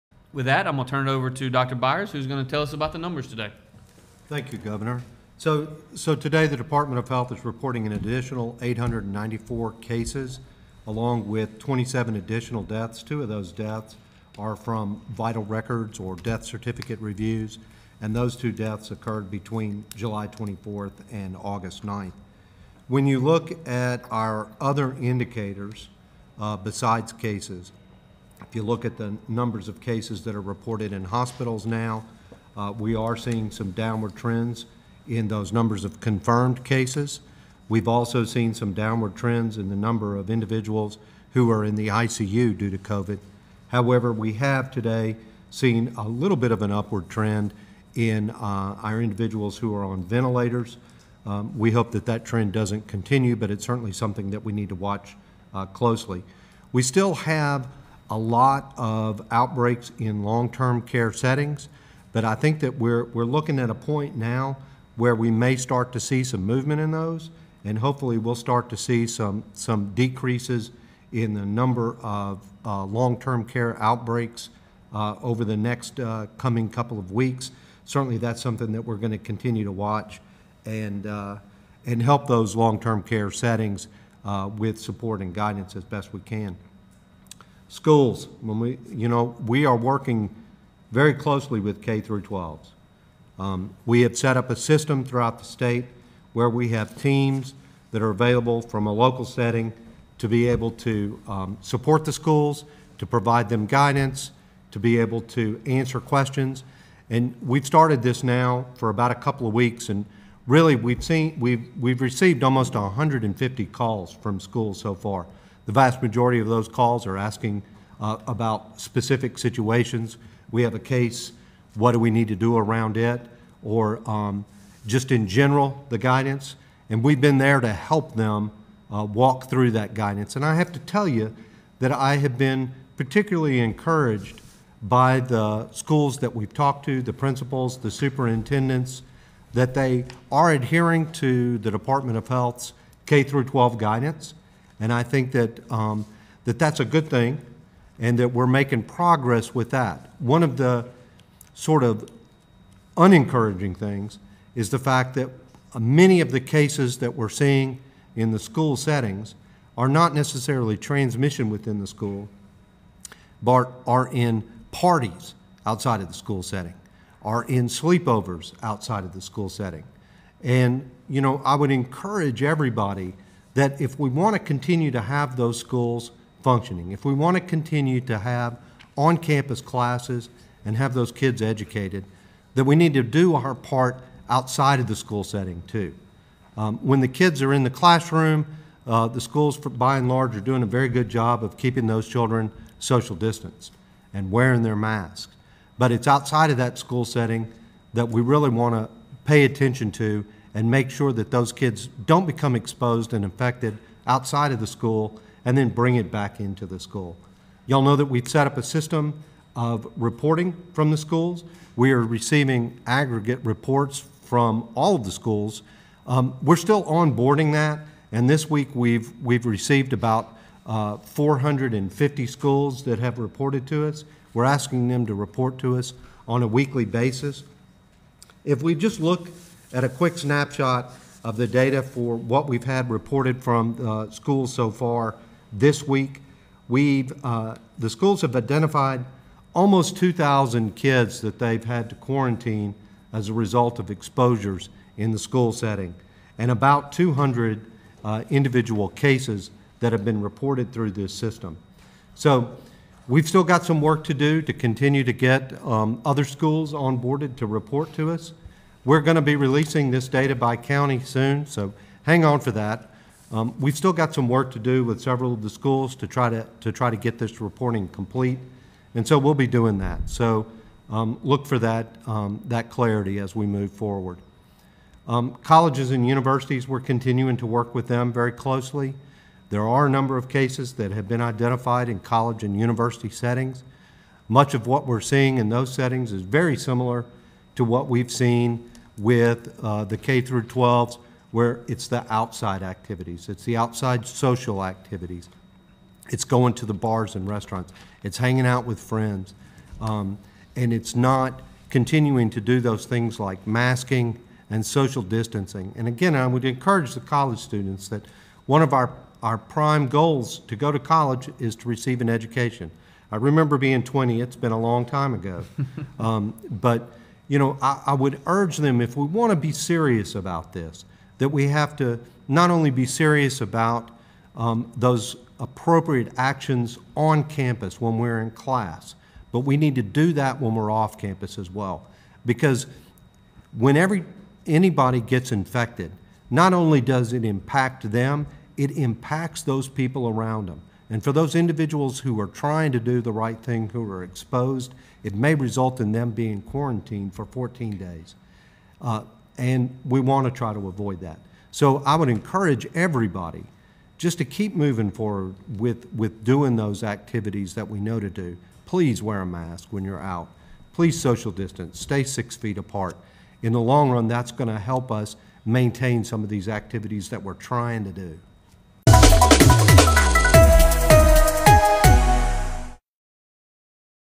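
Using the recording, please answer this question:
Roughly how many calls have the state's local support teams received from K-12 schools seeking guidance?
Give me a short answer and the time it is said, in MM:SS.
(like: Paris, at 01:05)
150, at 01:52.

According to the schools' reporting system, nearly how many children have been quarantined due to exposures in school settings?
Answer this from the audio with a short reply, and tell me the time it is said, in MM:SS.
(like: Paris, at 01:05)
2,000, at 03:59.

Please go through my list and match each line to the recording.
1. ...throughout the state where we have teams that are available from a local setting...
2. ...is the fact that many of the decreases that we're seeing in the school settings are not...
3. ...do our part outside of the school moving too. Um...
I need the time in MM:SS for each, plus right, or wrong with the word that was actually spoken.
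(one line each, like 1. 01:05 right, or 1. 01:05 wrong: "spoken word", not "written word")
1. 01:35 right
2. 02:34 wrong: "cases", not "decreases"
3. 03:03 wrong: "setting", not "moving".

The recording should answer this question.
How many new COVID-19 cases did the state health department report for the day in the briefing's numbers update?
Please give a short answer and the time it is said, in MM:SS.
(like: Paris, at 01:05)
894, at 00:08.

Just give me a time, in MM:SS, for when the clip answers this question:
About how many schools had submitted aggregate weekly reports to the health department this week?
03:40.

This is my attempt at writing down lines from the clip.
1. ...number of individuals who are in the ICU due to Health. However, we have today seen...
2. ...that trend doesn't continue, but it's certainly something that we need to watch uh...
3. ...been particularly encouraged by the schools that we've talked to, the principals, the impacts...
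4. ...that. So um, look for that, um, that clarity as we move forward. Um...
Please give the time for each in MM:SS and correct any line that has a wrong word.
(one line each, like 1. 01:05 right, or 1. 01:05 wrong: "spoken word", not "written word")
1. 00:39 wrong: "COVID", not "Health"
2. 00:52 right
3. 02:12 wrong: "superintendents", not "impacts"
4. 04:29 right.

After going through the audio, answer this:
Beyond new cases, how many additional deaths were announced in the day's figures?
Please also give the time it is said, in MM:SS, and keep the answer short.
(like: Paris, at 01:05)
27, at 00:11.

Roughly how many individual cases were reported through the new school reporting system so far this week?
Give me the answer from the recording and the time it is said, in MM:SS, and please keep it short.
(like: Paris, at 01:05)
200, at 04:06.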